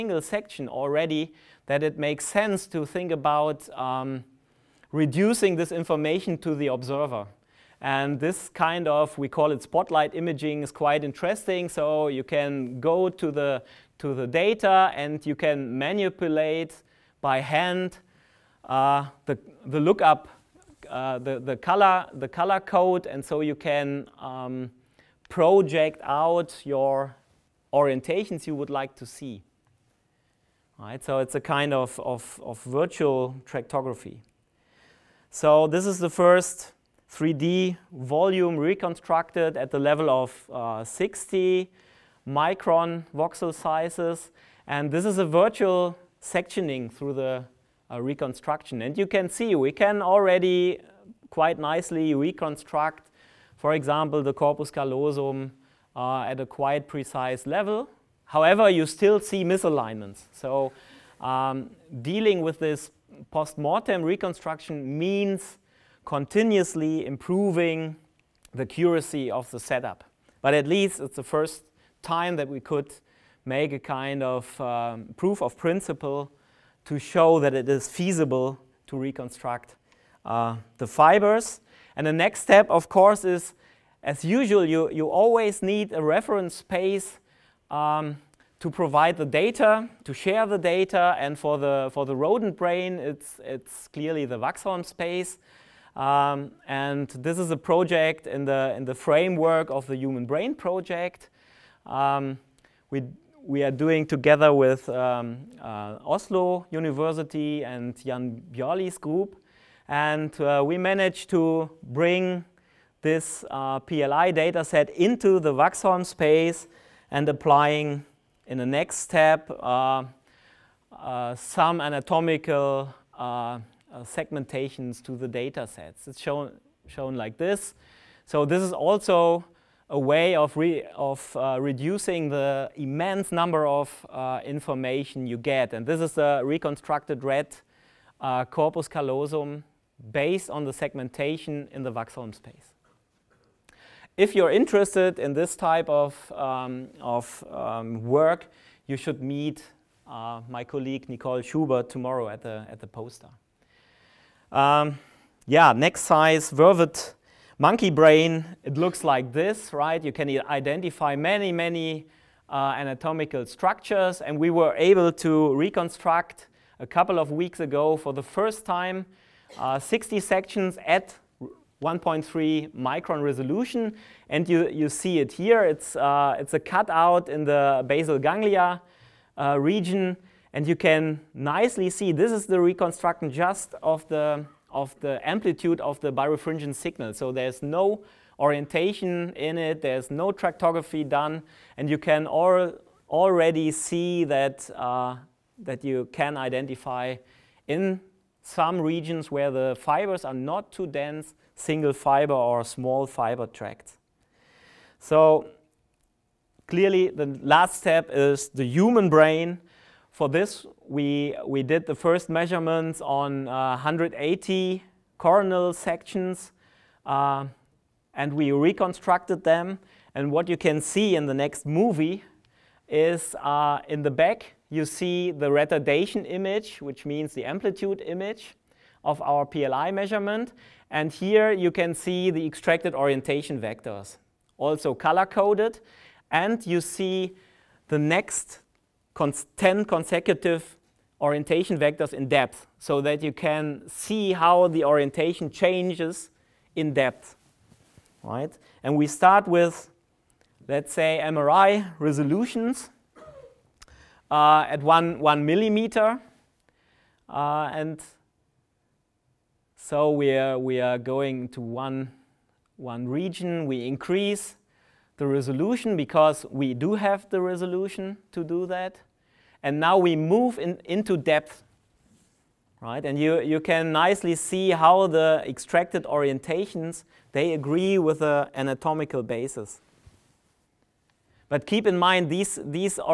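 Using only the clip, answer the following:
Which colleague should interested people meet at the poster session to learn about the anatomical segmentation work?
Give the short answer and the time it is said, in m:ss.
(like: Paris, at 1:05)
Nicole Schubert, at 2:31.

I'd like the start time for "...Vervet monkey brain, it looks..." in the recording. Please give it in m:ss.
2:36.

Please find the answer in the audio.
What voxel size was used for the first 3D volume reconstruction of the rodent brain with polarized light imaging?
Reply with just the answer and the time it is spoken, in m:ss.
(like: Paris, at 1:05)
60 micron, at 0:40.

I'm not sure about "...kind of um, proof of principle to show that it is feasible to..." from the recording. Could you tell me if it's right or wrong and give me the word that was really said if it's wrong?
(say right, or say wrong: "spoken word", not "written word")
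right.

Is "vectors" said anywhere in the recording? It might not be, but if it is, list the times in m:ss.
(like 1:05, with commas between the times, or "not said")
3:53, 4:01.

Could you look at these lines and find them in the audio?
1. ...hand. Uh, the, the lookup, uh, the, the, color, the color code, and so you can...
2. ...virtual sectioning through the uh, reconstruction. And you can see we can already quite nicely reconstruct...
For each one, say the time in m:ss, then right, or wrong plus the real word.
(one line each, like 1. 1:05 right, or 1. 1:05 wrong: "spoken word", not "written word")
1. 0:17 right
2. 0:45 right.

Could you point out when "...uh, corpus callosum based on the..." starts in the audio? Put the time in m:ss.
2:18.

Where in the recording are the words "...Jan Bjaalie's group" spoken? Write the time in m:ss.
1:48.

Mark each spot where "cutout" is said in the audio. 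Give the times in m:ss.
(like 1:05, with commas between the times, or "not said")
2:56.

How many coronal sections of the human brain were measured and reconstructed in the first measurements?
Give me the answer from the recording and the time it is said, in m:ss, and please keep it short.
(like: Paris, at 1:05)
180, at 3:33.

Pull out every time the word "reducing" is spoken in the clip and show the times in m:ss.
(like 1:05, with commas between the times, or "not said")
0:04, 2:11.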